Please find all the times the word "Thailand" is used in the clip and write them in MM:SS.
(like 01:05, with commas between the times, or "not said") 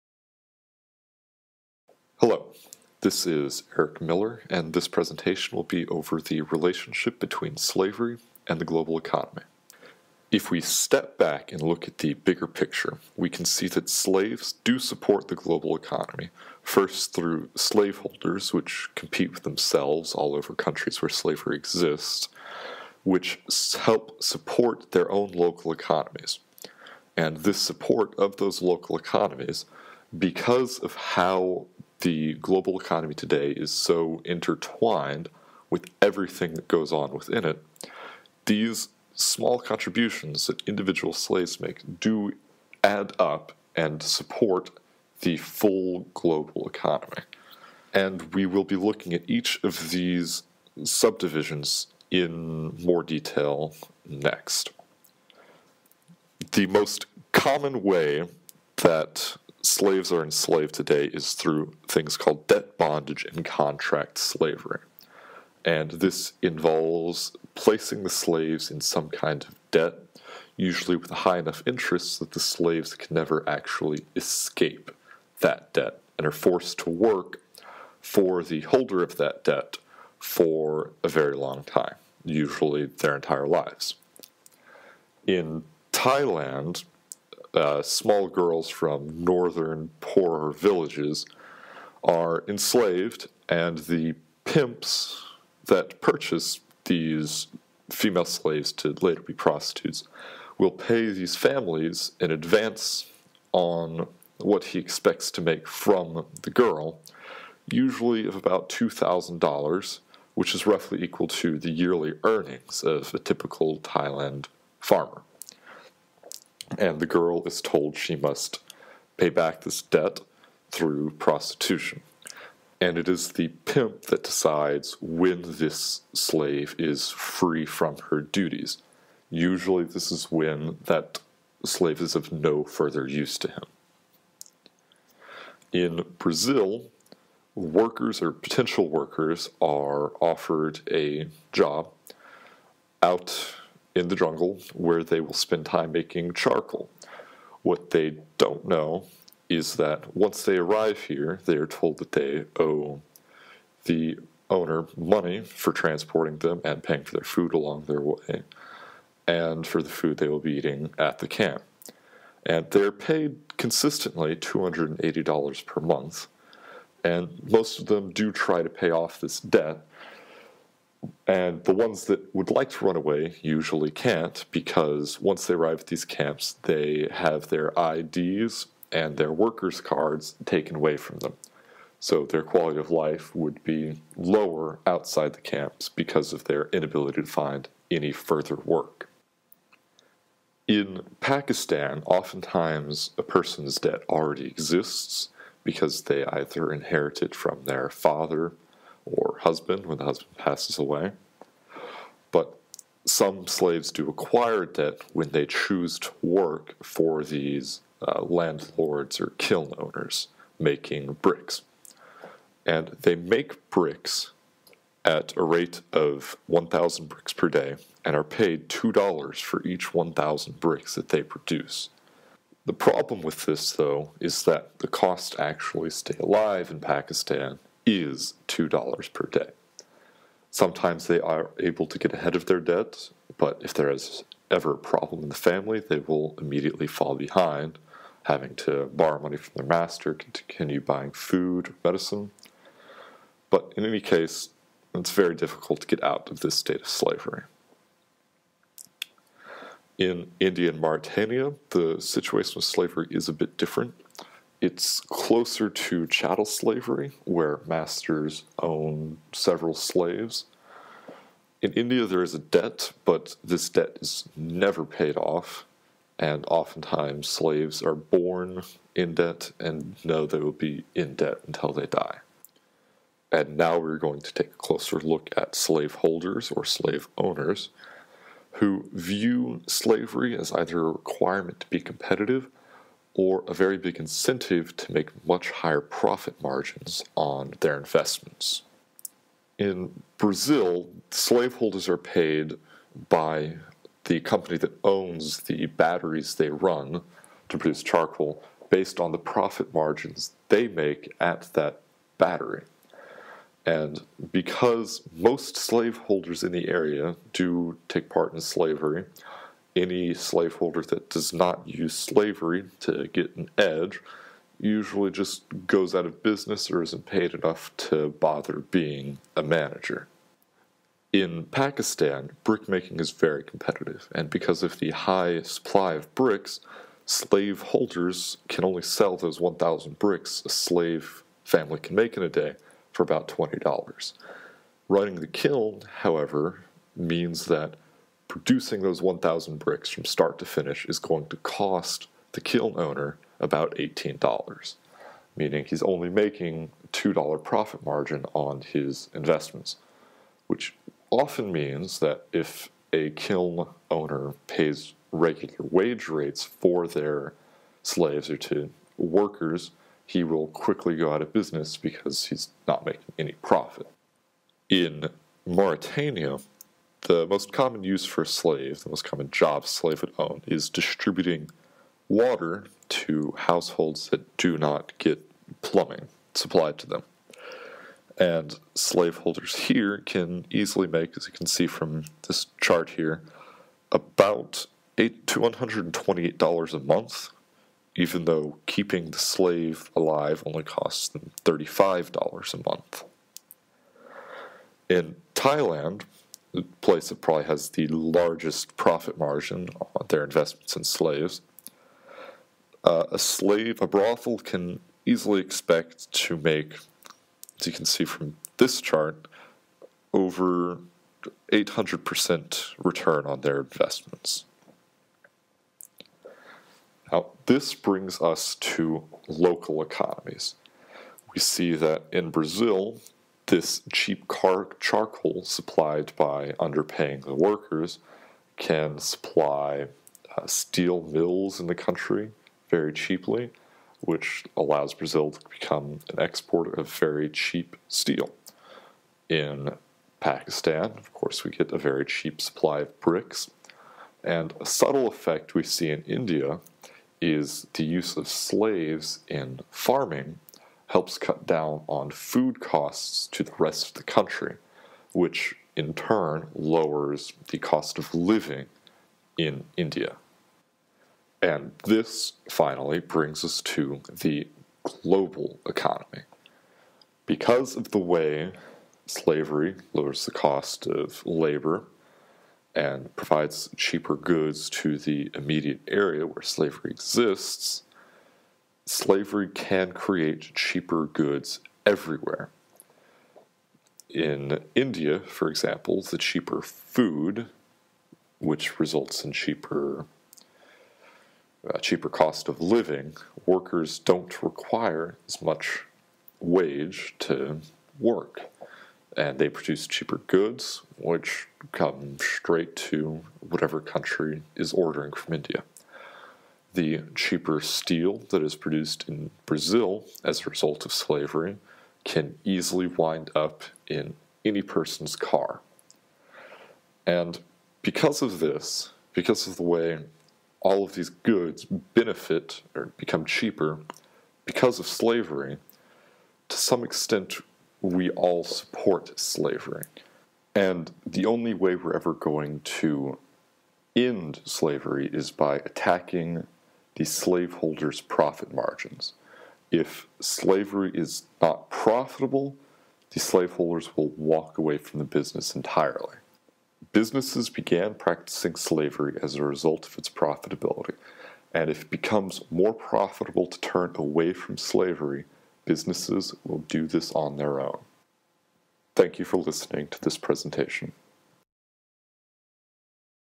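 01:25, 01:53, 06:35.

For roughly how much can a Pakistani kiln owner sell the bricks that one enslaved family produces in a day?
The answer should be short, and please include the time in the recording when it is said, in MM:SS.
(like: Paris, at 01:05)
$20, at 05:33.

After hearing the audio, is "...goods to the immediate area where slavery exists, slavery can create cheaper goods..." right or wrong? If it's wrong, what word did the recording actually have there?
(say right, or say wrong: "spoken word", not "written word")
right.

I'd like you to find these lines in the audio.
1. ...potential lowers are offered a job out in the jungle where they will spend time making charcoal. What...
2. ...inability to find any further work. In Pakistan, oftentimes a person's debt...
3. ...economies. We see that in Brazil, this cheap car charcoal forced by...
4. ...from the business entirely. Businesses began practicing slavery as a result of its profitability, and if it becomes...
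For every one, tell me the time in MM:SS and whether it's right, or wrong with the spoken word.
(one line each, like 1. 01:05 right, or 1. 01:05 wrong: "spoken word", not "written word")
1. 02:18 wrong: "workers", not "lowers"
2. 03:06 right
3. 06:59 wrong: "supplied", not "forced"
4. 09:04 right.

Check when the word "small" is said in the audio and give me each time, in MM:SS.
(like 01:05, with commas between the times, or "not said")
00:39, 01:27.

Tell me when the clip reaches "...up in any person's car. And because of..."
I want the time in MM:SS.
08:33.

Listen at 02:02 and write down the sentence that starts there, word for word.
And it is the pimp that decides when this slave is free from her duties.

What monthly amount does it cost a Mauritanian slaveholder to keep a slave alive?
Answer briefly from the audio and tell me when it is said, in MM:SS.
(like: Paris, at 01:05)
$35, at 06:31.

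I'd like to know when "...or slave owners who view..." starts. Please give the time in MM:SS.
04:36.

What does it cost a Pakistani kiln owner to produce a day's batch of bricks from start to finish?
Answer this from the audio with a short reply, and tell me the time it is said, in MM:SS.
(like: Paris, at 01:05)
$18, at 05:43.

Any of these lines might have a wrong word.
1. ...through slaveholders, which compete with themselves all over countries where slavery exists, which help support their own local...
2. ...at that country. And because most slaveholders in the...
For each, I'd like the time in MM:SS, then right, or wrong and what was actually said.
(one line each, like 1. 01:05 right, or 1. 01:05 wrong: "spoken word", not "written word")
1. 00:17 right
2. 05:01 wrong: "battery", not "country".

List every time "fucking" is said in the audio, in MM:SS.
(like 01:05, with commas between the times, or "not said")
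not said.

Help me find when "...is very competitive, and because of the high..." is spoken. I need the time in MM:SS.
05:23.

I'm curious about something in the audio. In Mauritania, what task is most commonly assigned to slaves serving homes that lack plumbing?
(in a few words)
distributing water.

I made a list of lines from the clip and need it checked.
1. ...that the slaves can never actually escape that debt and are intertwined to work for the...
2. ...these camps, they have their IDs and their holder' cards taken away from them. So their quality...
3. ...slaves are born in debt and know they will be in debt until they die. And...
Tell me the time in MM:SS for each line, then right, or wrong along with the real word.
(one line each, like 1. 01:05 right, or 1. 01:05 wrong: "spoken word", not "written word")
1. 01:12 wrong: "forced", not "intertwined"
2. 02:55 wrong: "workers", not "holder"
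3. 04:27 right.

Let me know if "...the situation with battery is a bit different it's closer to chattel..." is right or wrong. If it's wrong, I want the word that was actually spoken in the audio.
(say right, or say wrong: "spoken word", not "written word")
wrong: "slavery", not "battery".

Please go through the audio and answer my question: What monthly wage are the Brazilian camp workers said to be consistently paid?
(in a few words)
$280.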